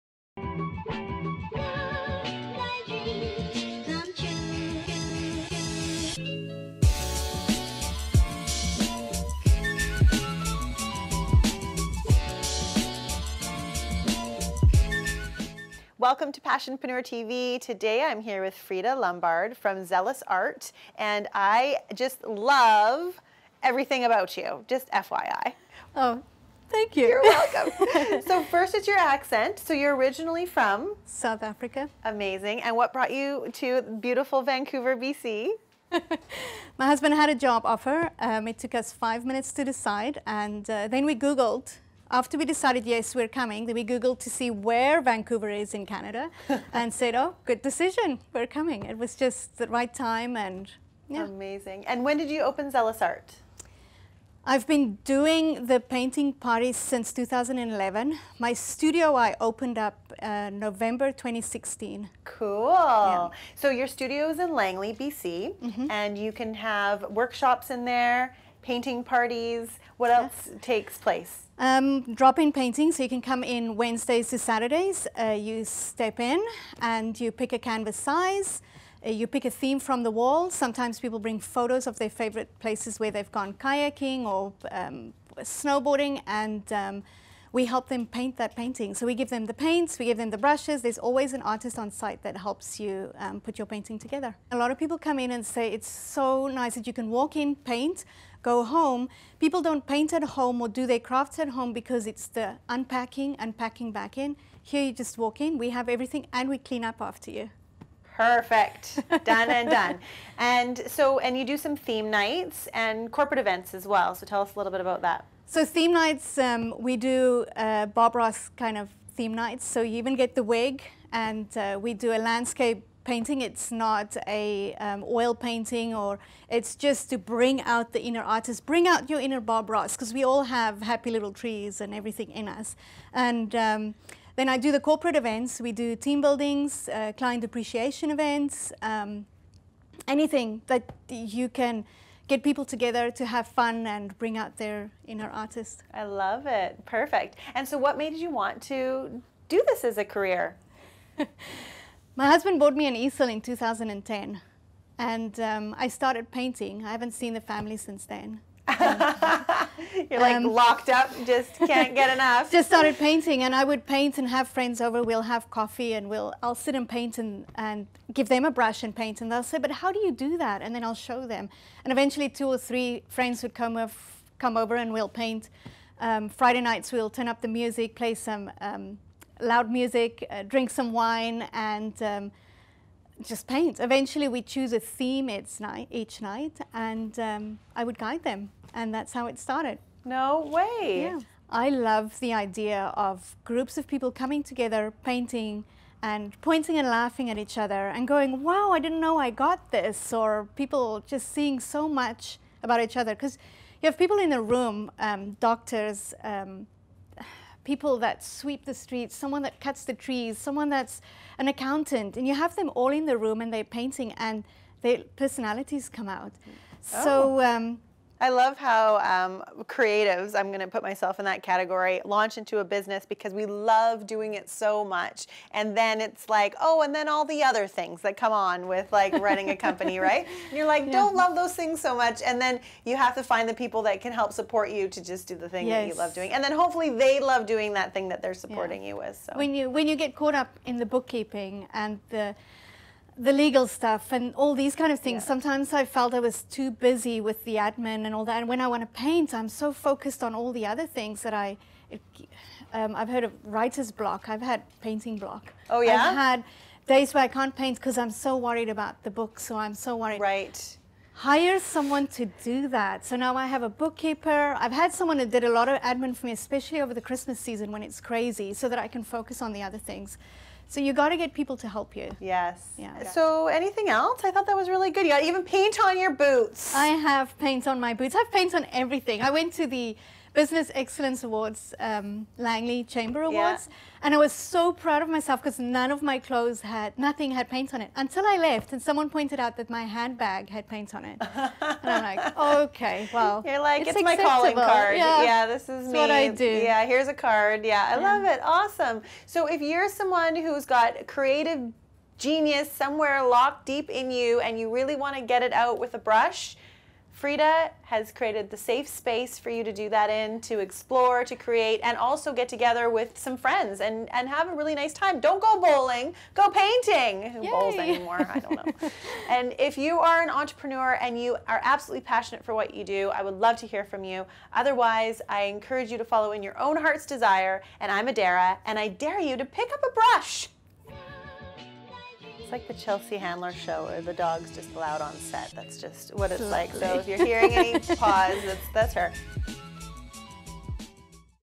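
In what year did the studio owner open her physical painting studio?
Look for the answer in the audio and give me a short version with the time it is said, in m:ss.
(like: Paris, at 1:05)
2016, at 1:00.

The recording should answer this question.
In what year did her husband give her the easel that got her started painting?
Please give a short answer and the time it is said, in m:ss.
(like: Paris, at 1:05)
2010, at 2:33.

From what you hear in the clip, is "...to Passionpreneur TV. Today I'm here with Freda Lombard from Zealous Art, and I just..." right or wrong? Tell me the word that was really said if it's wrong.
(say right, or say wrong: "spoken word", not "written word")
right.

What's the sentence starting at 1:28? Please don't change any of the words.
So we give them the paints, we give them the brushes.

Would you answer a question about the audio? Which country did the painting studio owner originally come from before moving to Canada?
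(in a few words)
South Africa.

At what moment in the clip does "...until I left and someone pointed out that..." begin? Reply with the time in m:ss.
4:47.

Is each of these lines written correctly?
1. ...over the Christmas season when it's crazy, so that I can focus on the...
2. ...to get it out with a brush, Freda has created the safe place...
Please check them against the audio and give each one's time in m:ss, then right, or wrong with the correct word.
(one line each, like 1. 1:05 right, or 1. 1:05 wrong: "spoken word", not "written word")
1. 4:26 right
2. 5:05 wrong: "space", not "place".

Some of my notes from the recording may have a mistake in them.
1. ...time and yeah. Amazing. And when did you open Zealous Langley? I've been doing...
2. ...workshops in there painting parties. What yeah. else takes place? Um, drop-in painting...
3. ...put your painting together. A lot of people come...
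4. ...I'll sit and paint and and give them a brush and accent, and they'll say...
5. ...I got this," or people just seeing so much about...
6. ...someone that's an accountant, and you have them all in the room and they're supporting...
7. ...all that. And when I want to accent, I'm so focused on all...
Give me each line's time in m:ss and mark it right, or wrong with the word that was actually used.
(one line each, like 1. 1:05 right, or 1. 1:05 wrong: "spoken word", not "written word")
1. 0:49 wrong: "Art", not "Langley"
2. 1:07 right
3. 1:33 right
4. 2:46 wrong: "paint", not "accent"
5. 3:19 right
6. 3:30 wrong: "painting", not "supporting"
7. 4:08 wrong: "paint", not "accent".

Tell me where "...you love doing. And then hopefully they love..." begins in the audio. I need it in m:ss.
3:55.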